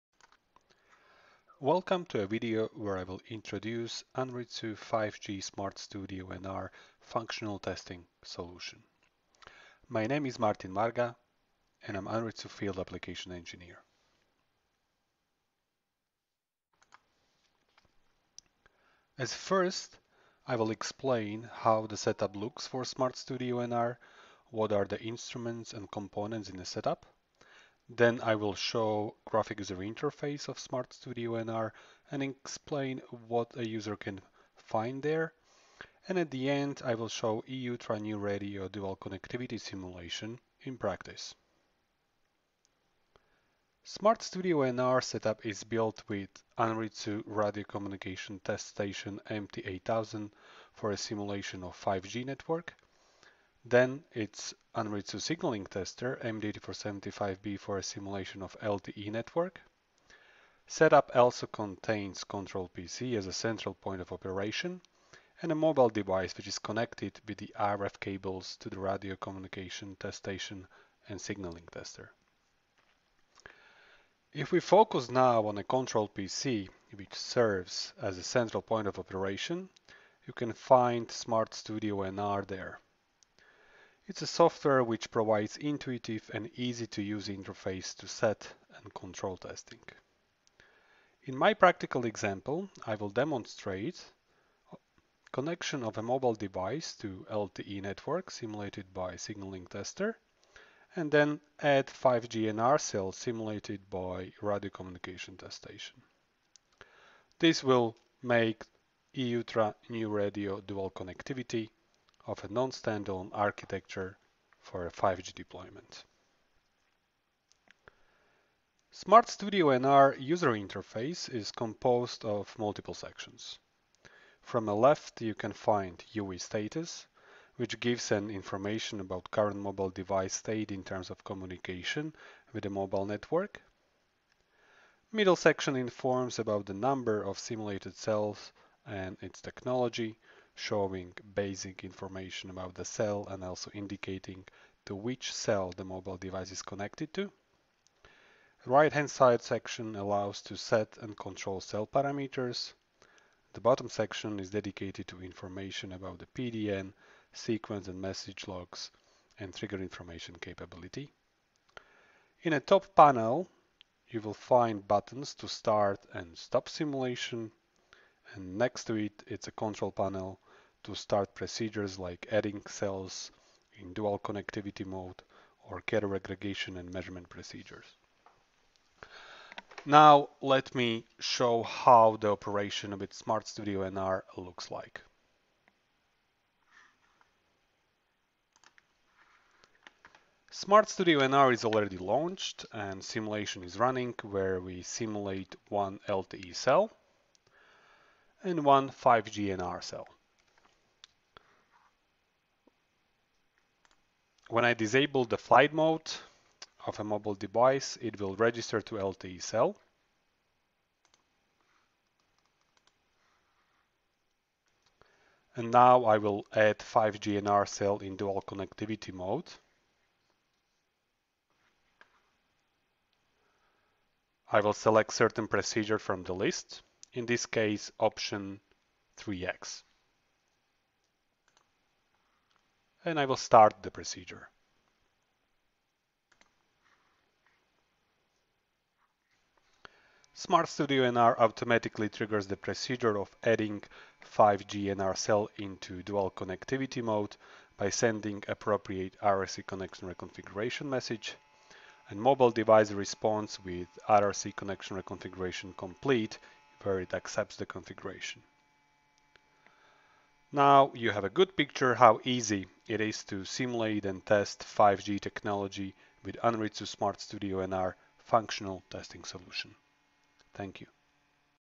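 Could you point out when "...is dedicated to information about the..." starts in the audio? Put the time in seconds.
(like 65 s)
154 s.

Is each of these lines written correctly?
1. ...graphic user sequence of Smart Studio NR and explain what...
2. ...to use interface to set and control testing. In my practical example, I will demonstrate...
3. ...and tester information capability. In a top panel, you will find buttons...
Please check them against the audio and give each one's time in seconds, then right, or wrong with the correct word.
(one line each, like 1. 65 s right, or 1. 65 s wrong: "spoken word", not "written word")
1. 29 s wrong: "interface", not "sequence"
2. 86 s right
3. 159 s wrong: "trigger", not "tester".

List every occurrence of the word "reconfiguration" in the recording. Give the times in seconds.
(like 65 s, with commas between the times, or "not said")
250 s, 255 s.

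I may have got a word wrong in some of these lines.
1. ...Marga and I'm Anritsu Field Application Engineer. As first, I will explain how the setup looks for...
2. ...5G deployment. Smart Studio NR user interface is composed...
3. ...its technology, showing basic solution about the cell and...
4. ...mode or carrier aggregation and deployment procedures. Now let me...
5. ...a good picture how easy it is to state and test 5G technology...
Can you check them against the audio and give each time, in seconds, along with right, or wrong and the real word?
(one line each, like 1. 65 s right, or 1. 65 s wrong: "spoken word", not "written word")
1. 10 s right
2. 114 s right
3. 139 s wrong: "information", not "solution"
4. 174 s wrong: "measurement", not "deployment"
5. 261 s wrong: "simulate", not "state".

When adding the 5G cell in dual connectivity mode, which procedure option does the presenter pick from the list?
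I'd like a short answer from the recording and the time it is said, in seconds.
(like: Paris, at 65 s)
Option 3x, at 227 s.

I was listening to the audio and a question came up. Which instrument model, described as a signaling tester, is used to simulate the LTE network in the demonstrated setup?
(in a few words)
MD8475B.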